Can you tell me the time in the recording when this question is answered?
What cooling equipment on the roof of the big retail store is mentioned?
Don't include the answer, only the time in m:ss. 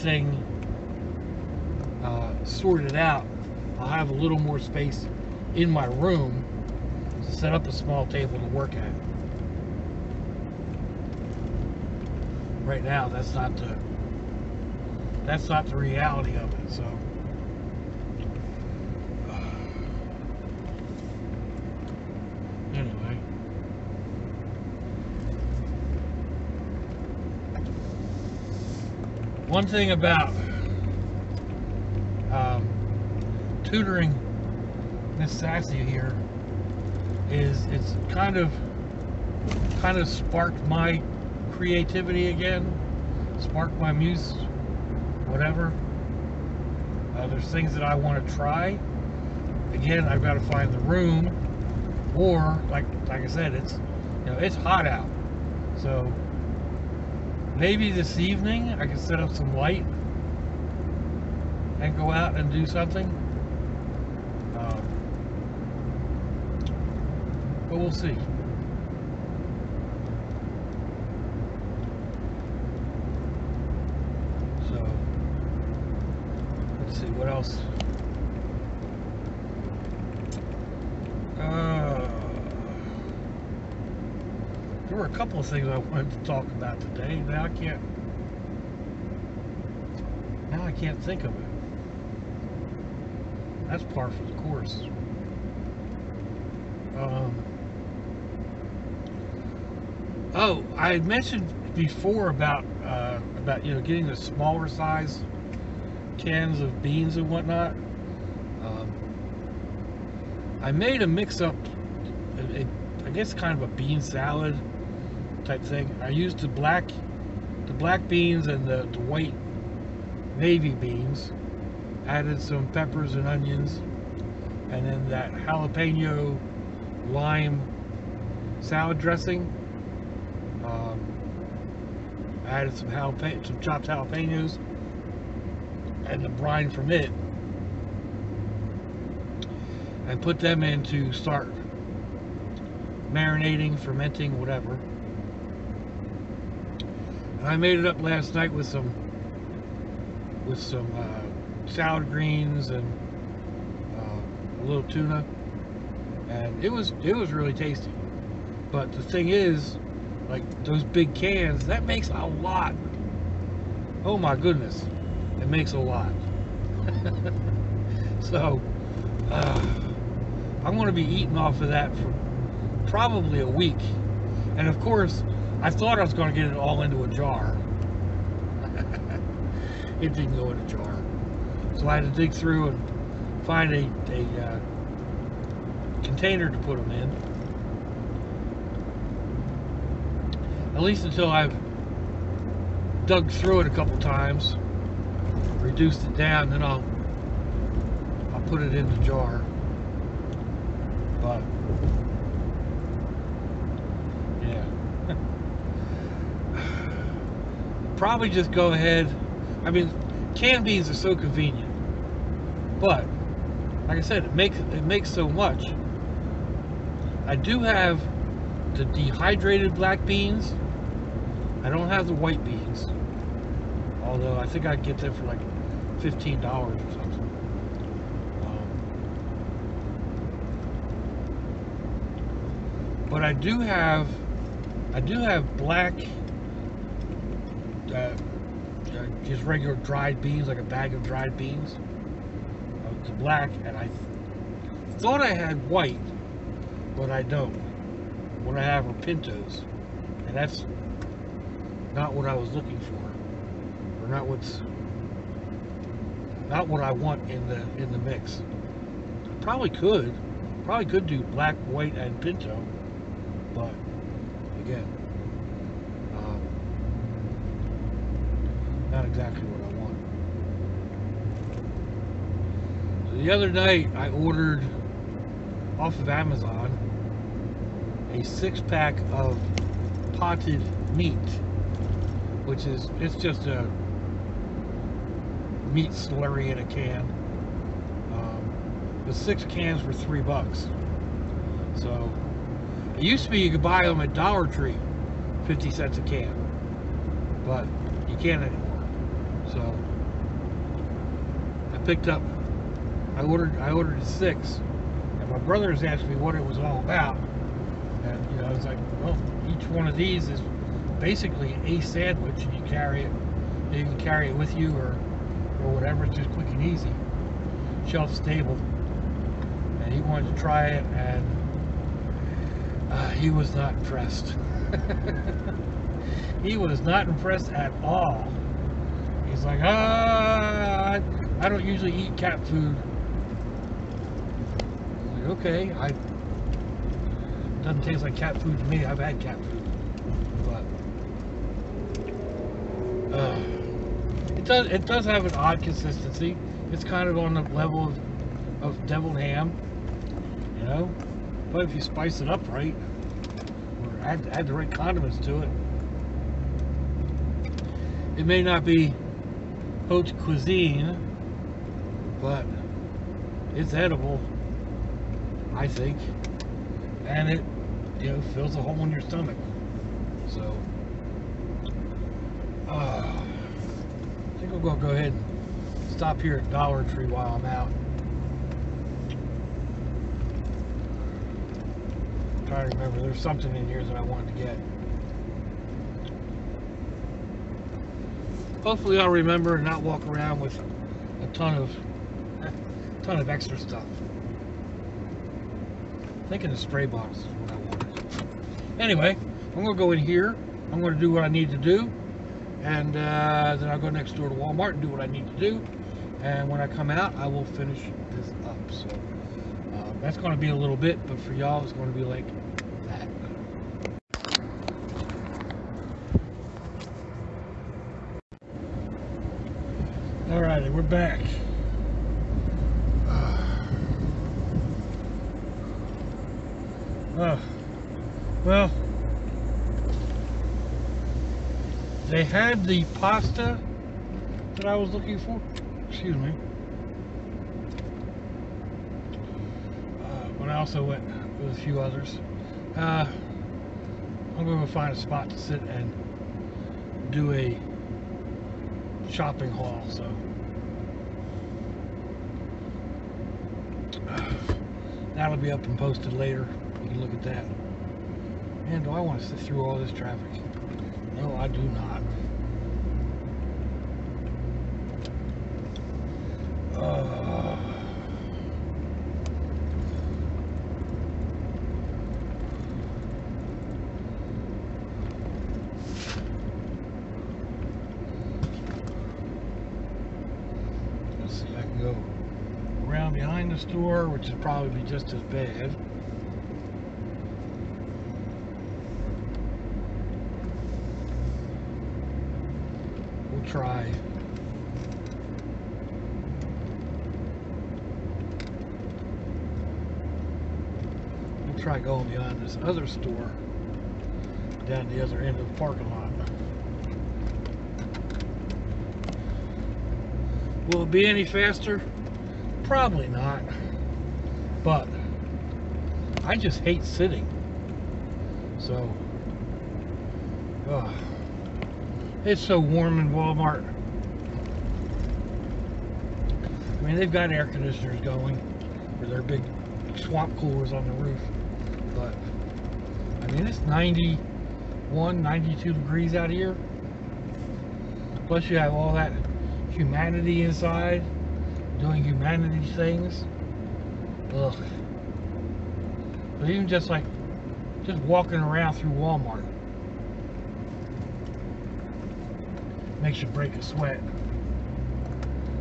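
8:49.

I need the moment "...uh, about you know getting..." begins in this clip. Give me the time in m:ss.
1:42.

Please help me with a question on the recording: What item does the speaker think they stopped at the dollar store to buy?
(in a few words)
Spray bottles.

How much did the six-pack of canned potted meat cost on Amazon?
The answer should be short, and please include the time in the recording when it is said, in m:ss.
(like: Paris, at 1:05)
$3, at 4:49.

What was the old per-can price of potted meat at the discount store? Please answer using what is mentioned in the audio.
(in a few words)
50 cents.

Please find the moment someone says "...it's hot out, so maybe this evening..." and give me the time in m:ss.
0:54.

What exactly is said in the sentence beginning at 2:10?
Um, I added some jalapeno, some chopped jalapenos, and the brine from it, and put them in to start marinating, fermenting, whatever.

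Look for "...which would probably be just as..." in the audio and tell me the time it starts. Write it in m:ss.
8:04.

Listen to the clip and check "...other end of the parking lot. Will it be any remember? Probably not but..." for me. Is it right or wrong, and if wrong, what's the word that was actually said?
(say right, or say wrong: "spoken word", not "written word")
wrong: "faster", not "remember".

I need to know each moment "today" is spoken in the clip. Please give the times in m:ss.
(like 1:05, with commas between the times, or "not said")
1:26.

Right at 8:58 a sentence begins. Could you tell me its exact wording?
Plus you have all that humanity inside doing humanity things.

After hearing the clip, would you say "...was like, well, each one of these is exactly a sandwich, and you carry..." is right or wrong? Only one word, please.
wrong.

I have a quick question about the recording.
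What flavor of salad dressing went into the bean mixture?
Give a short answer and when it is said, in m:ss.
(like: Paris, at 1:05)
Jalapeno lime, at 2:05.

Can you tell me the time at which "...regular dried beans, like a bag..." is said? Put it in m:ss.
3:59.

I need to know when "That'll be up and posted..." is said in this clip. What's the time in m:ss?
7:35.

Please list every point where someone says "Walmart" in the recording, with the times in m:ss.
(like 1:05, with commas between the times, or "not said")
6:44, 8:43, 9:08.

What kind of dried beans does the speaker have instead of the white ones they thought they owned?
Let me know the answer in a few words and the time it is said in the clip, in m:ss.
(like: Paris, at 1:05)
Pintos, at 4:09.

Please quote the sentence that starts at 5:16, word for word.
It's just quick and easy, shelf stable.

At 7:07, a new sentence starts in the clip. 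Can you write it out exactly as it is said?
Uh, well, they had the pasta that I was looking for.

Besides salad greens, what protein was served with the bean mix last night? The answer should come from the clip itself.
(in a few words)
Tuna.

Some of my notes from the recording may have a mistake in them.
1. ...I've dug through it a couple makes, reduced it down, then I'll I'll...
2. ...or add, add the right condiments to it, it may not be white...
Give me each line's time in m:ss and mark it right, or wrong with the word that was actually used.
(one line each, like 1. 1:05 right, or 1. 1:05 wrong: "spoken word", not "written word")
1. 3:11 wrong: "times", not "makes"
2. 5:53 wrong: "haute", not "white".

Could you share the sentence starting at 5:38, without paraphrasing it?
I've had cat food, but uh, it does it does have an odd consistency.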